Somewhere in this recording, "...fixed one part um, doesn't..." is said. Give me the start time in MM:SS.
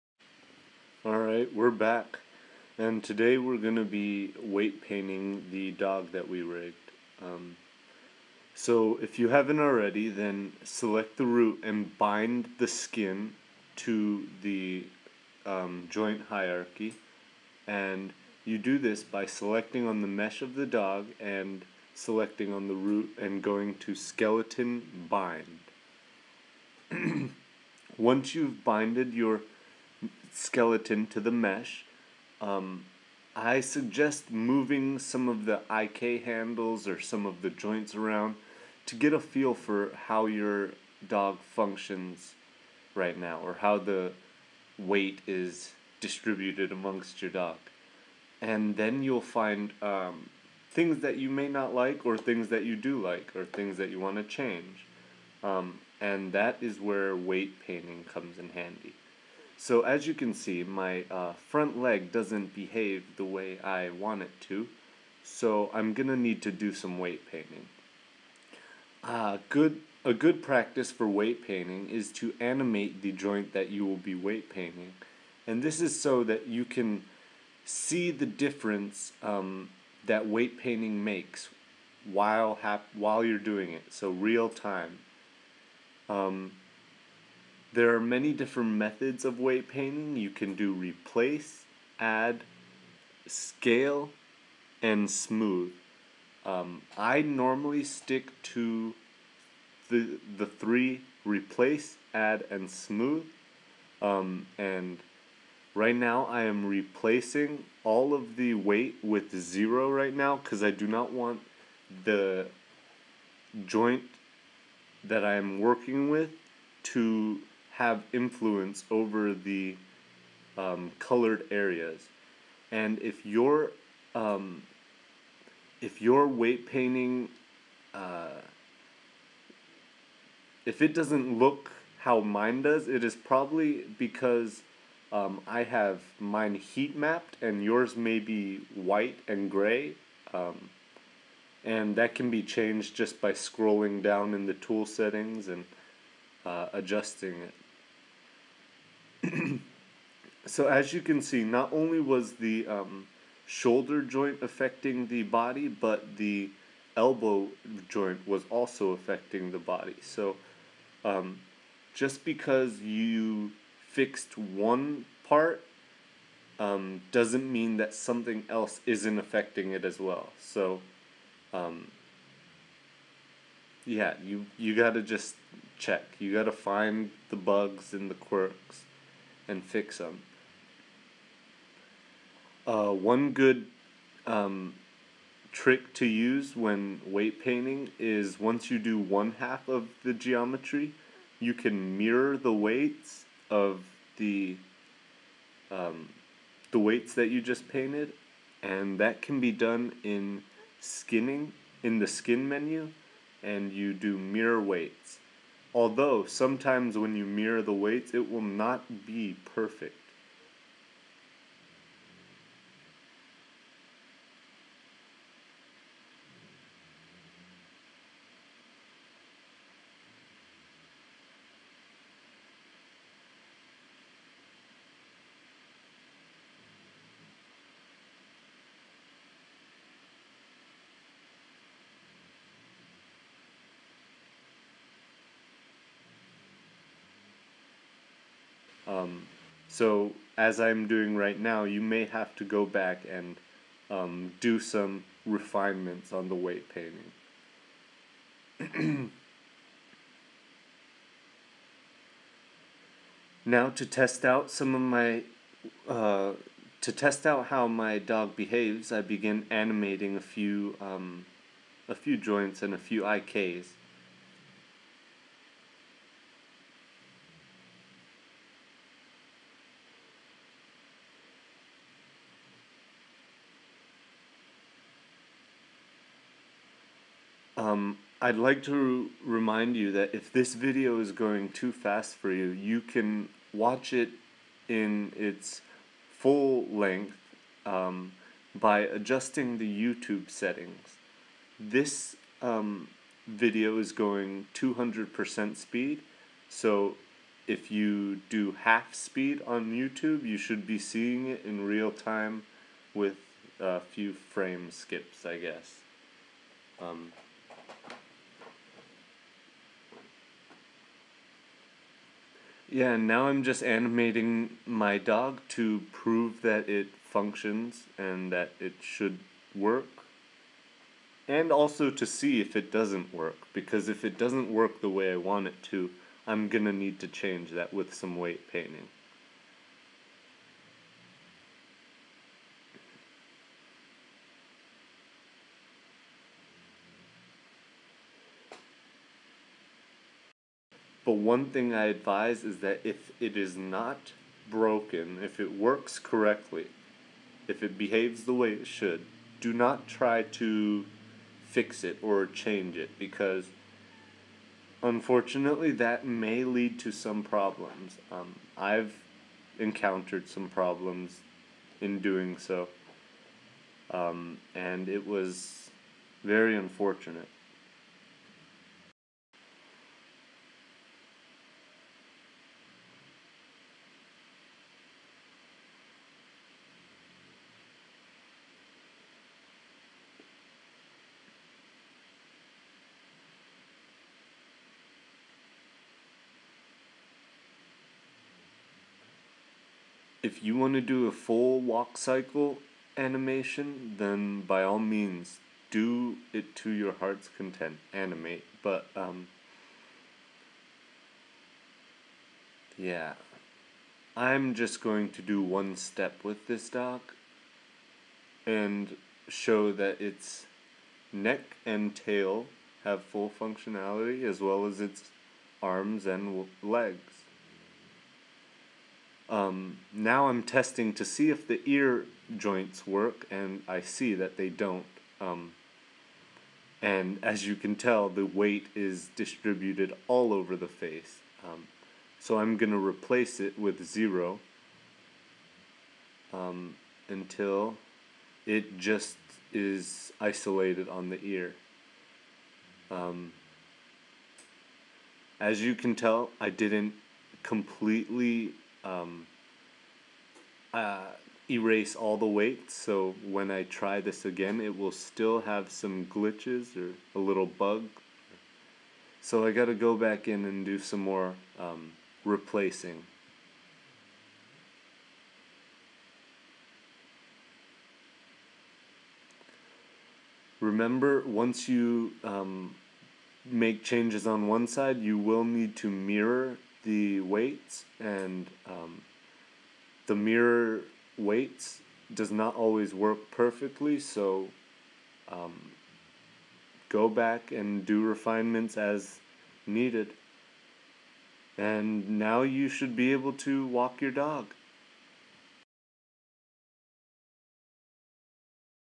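02:43.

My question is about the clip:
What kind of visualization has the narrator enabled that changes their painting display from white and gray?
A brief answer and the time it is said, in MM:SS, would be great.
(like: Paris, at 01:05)
Heat mapped, at 02:16.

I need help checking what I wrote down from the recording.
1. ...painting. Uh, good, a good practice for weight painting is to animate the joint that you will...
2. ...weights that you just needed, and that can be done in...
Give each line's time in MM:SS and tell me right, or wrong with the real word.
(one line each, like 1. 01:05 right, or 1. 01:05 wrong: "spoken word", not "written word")
1. 01:07 right
2. 03:16 wrong: "painted", not "needed".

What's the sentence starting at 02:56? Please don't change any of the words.
You gotta find the bugs and the quirks and fix them.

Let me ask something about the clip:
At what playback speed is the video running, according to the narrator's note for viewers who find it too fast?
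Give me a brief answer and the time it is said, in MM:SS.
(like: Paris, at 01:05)
200%, at 04:54.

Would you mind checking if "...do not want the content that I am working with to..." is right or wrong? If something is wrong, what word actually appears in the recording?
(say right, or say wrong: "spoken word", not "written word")
wrong: "joint", not "content".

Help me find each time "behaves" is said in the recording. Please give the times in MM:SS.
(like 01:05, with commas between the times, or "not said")
01:02, 04:18, 05:47.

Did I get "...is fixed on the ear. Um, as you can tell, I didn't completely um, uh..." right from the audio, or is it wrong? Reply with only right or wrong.
wrong.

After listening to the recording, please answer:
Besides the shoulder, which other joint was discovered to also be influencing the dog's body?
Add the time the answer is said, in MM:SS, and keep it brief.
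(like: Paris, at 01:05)
Elbow joint, at 02:36.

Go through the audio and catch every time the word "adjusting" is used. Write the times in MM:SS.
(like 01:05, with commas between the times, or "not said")
02:26, 04:48.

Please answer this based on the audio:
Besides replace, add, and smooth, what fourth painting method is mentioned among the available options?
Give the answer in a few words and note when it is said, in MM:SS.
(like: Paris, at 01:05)
Scale, at 01:33.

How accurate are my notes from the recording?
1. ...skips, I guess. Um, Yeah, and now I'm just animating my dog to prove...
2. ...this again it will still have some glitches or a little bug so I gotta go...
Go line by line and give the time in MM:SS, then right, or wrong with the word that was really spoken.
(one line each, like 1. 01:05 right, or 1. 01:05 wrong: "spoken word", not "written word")
1. 05:04 right
2. 07:33 right.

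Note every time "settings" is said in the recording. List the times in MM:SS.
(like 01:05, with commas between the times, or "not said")
02:24, 04:50.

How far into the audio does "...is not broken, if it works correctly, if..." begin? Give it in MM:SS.
05:43.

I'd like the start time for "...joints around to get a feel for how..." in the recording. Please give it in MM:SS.
00:37.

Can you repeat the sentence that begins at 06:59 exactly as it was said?
Um, now I'm testing to see if the ear joints work, and I see that they don't.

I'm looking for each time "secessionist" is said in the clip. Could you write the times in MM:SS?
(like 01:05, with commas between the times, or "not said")
not said.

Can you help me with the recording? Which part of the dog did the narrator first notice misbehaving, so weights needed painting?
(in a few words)
Front leg.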